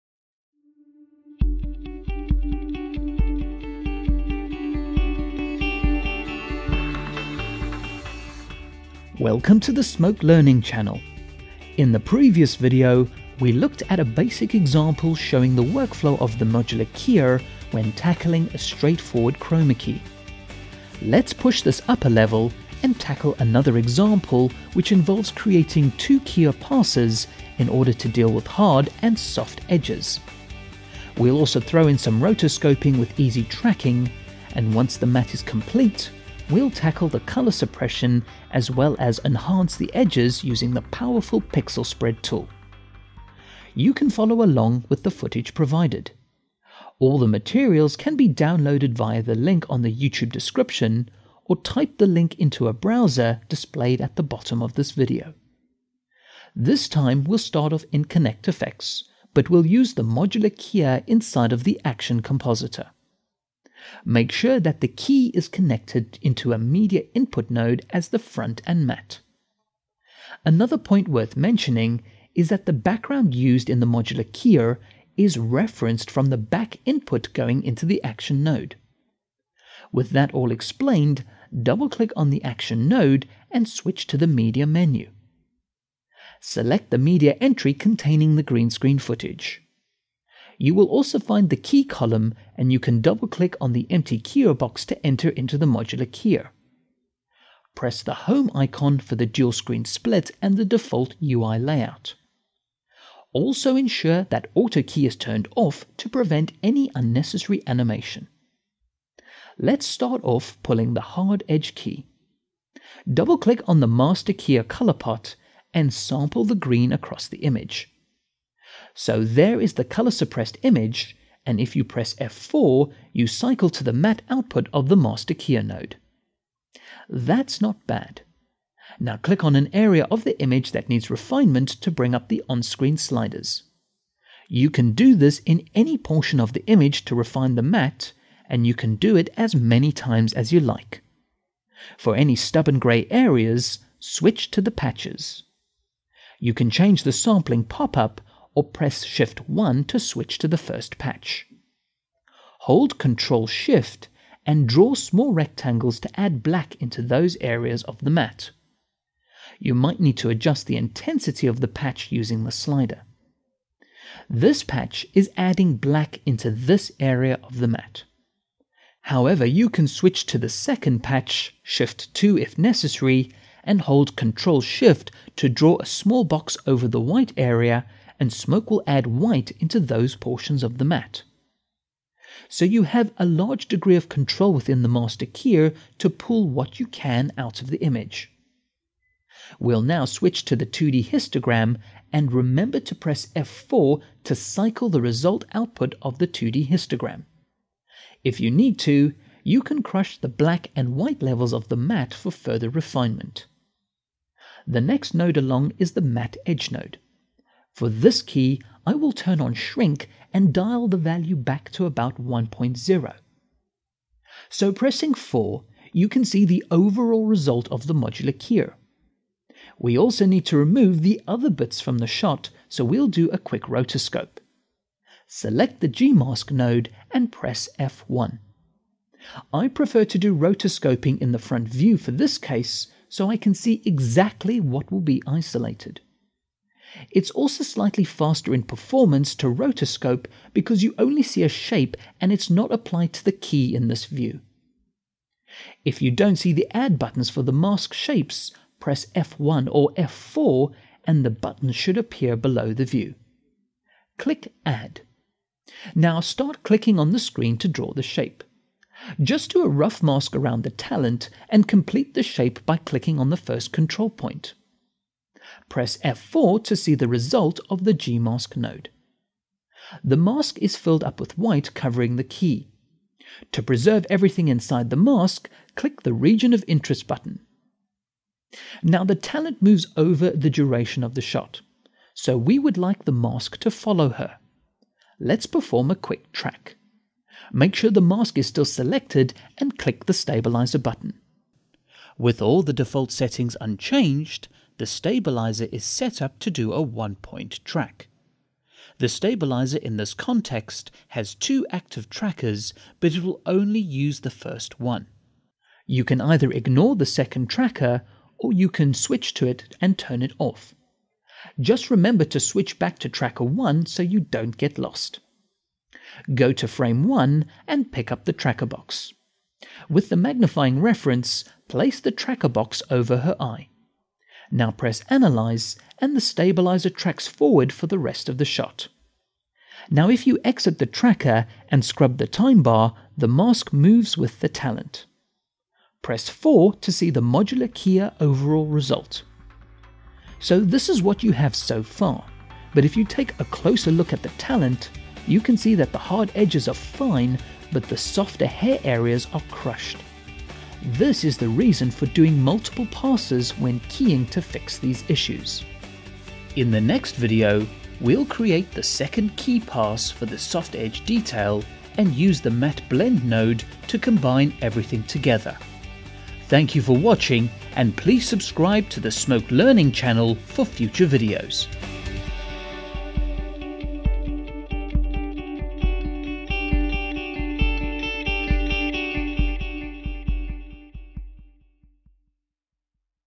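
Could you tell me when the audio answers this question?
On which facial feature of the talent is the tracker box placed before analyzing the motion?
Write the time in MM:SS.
05:23.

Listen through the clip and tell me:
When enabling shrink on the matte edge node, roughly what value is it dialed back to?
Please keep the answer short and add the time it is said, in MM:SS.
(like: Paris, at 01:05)
1.0, at 03:32.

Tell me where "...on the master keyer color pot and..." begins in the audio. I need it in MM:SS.
01:53.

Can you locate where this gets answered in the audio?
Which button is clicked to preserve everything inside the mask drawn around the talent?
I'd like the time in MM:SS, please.
04:36.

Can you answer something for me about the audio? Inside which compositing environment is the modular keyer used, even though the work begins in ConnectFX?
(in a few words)
Action Compositor.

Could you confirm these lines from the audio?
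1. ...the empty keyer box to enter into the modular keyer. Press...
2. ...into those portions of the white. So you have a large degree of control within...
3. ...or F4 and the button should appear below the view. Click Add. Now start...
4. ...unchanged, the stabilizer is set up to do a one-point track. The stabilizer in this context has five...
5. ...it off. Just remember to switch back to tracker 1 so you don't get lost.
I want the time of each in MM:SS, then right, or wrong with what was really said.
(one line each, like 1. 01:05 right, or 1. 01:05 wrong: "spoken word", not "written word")
1. 01:33 right
2. 02:59 wrong: "matte", not "white"
3. 04:09 right
4. 04:53 wrong: "two", not "five"
5. 05:10 right.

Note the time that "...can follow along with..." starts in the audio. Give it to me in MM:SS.
00:43.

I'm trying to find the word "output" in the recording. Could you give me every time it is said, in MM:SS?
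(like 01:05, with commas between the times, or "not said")
02:04, 03:15.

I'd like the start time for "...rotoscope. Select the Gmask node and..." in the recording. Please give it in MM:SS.
03:43.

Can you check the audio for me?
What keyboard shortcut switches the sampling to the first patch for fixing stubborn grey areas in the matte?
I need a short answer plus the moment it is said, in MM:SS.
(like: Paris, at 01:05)
Shift 1, at 02:29.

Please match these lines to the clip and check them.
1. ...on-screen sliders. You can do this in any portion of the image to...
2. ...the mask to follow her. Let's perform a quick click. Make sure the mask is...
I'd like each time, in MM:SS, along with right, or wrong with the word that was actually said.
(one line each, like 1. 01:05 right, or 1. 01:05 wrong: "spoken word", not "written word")
1. 02:12 right
2. 04:43 wrong: "track", not "click".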